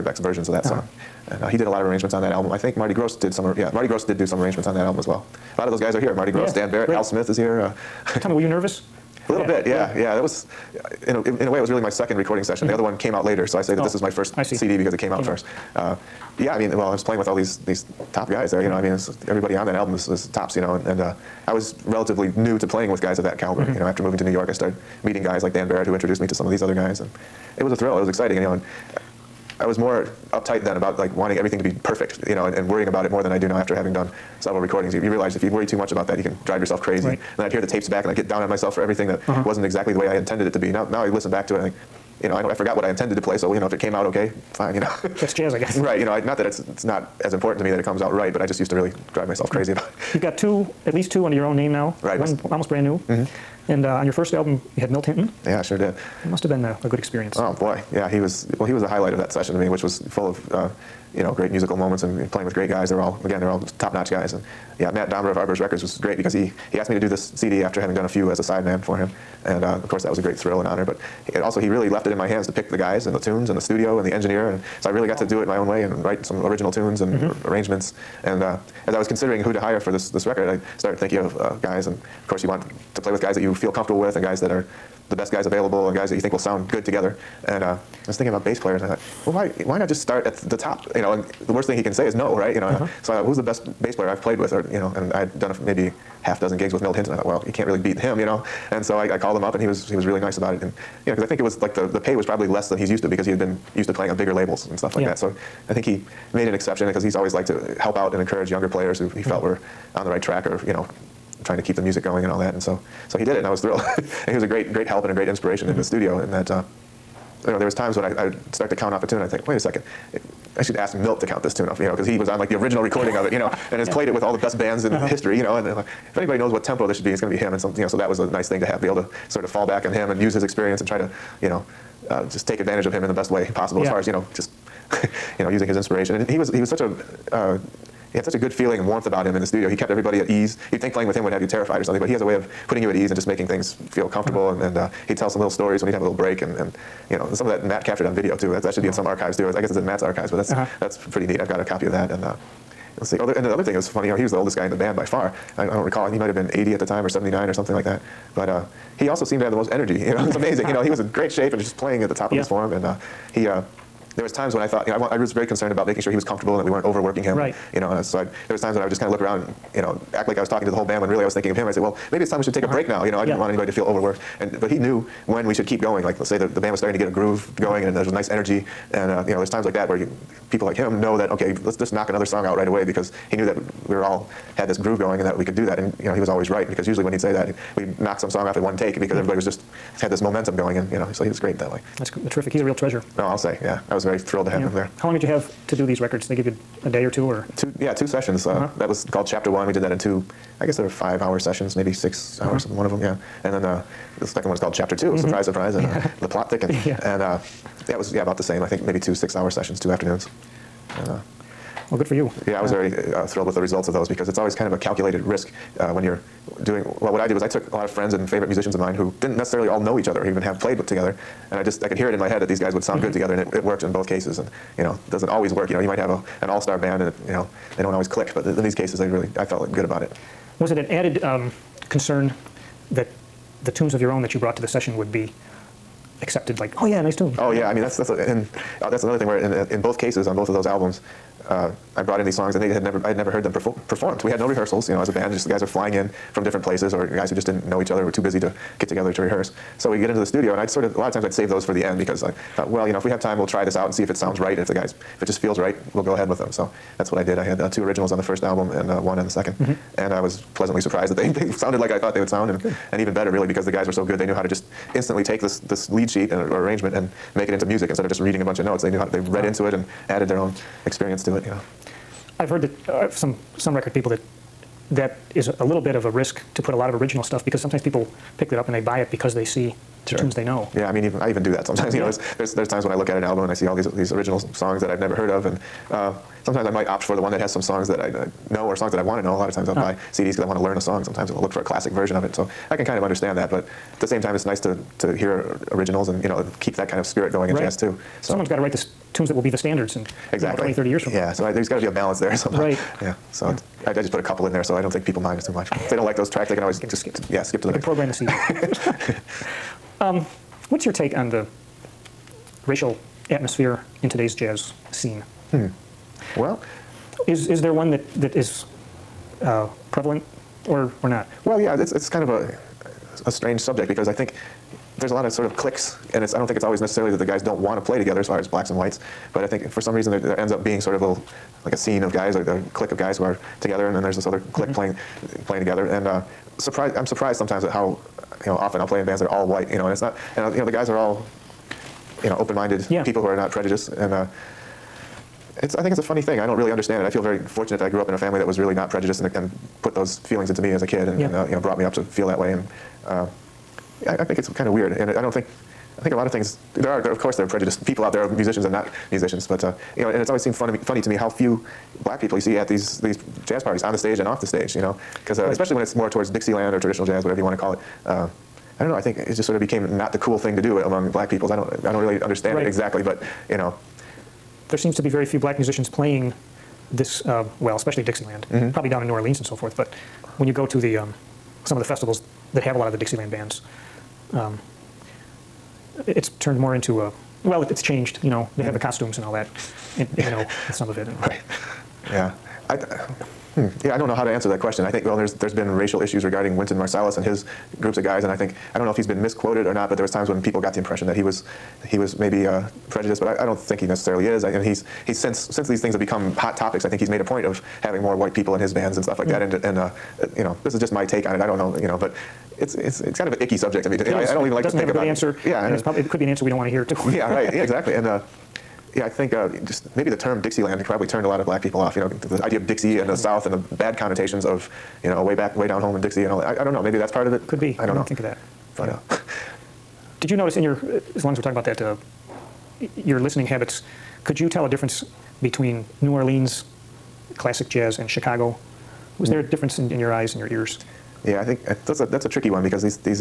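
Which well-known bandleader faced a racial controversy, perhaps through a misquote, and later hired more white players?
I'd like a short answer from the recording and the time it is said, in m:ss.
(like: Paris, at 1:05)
Wynton Marsalis, at 6:36.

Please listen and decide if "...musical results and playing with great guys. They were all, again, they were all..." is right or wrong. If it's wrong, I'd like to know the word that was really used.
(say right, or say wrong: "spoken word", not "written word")
wrong: "moments", not "results".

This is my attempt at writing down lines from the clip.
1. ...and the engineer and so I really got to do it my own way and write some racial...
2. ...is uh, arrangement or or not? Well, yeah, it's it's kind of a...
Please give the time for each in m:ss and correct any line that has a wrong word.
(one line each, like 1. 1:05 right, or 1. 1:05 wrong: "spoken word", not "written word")
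1. 1:13 wrong: "original", not "racial"
2. 5:18 wrong: "prevalent", not "arrangement".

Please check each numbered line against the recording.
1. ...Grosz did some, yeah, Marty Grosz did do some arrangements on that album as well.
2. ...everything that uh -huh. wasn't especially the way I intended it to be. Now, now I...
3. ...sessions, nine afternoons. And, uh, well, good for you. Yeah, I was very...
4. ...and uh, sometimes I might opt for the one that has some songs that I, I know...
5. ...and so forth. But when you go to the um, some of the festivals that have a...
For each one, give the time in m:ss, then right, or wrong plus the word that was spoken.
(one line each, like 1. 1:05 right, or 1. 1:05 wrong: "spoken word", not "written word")
1. 0:02 right
2. 0:38 wrong: "exactly", not "especially"
3. 3:29 wrong: "two", not "nine"
4. 4:45 right
5. 6:19 right.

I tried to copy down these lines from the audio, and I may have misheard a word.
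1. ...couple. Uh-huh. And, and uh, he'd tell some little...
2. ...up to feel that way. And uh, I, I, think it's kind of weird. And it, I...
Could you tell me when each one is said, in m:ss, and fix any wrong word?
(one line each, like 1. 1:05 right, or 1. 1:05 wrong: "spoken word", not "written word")
1. 2:24 wrong: "comfortable", not "couple"
2. 5:51 right.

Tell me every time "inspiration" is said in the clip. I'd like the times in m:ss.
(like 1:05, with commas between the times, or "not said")
1:55, 2:15.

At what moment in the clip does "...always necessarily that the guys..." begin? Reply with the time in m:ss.
5:26.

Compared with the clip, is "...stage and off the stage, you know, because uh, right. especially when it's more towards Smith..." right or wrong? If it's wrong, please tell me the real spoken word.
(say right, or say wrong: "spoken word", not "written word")
wrong: "Dixieland", not "Smith".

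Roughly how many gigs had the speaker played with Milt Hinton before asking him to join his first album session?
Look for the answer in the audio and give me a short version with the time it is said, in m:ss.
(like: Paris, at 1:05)
6, at 1:36.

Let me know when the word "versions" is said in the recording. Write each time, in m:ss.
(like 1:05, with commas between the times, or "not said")
0:00, 4:51.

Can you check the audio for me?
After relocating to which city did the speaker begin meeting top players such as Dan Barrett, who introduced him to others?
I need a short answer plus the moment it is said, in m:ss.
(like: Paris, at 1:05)
New York, at 0:24.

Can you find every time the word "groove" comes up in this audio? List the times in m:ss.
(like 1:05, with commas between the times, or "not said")
2:57, 3:04.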